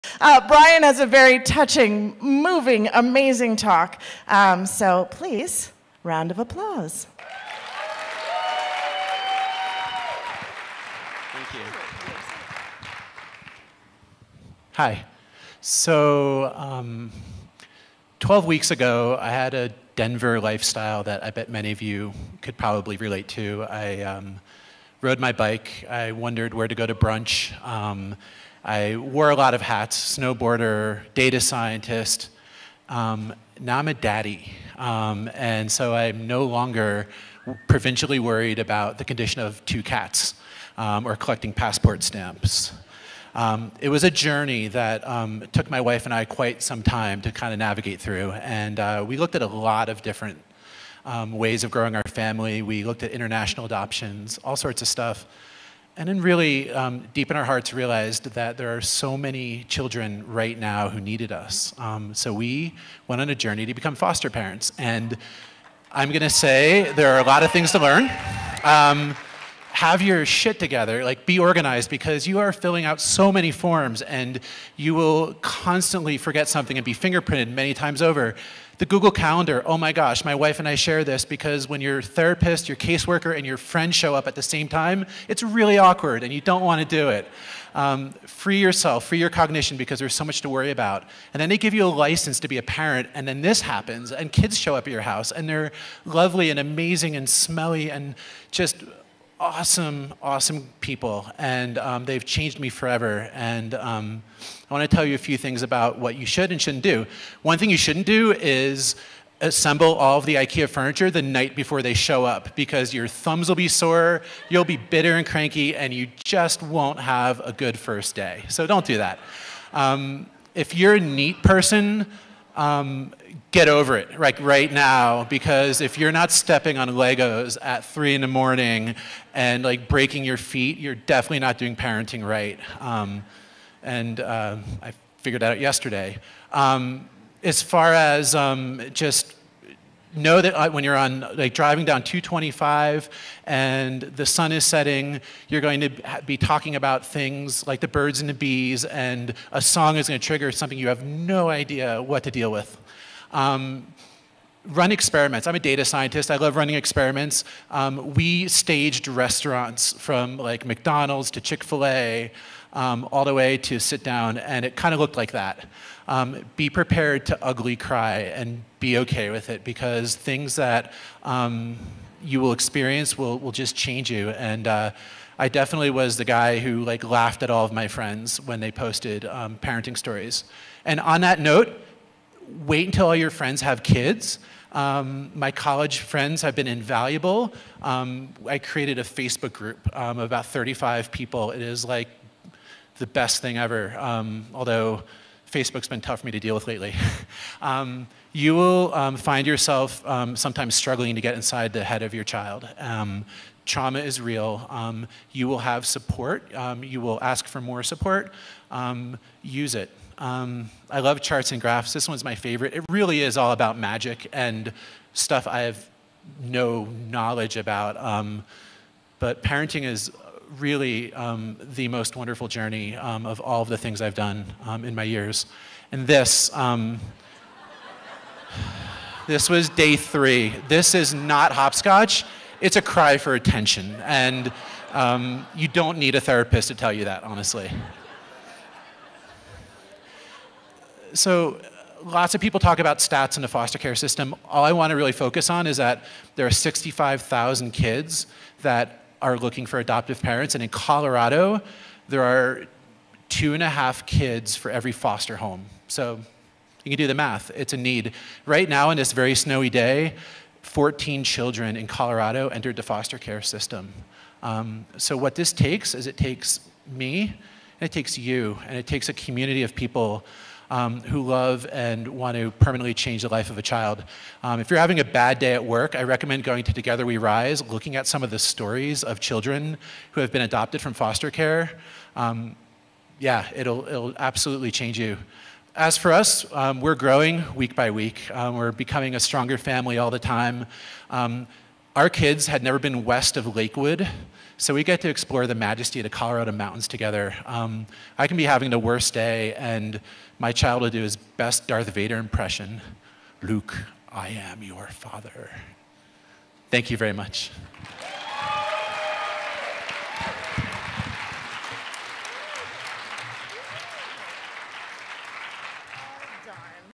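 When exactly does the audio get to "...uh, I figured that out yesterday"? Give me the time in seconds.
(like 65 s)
134 s.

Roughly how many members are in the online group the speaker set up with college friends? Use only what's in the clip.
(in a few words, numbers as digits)
35.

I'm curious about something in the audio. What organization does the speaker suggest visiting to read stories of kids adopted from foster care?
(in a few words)
Together We Rise.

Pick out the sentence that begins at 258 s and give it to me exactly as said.
Right now, on this very snowy day, 14 children in Colorado entered the foster care system.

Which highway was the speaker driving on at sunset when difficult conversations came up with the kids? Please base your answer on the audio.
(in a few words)
225.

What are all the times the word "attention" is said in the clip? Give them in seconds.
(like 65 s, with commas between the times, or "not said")
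233 s.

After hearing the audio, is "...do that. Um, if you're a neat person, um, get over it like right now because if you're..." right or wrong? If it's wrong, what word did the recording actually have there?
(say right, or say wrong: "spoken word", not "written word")
right.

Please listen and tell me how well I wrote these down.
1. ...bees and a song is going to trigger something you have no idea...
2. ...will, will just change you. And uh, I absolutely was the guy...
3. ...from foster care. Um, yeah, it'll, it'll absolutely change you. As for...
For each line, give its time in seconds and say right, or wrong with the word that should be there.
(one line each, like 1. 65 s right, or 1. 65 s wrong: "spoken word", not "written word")
1. 148 s right
2. 173 s wrong: "definitely", not "absolutely"
3. 280 s right.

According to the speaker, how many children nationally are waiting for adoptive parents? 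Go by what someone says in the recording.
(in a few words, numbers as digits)
65,000.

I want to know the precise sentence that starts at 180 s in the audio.
And on that note, wait until all your friends have kids.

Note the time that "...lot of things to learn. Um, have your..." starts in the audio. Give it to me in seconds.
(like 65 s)
67 s.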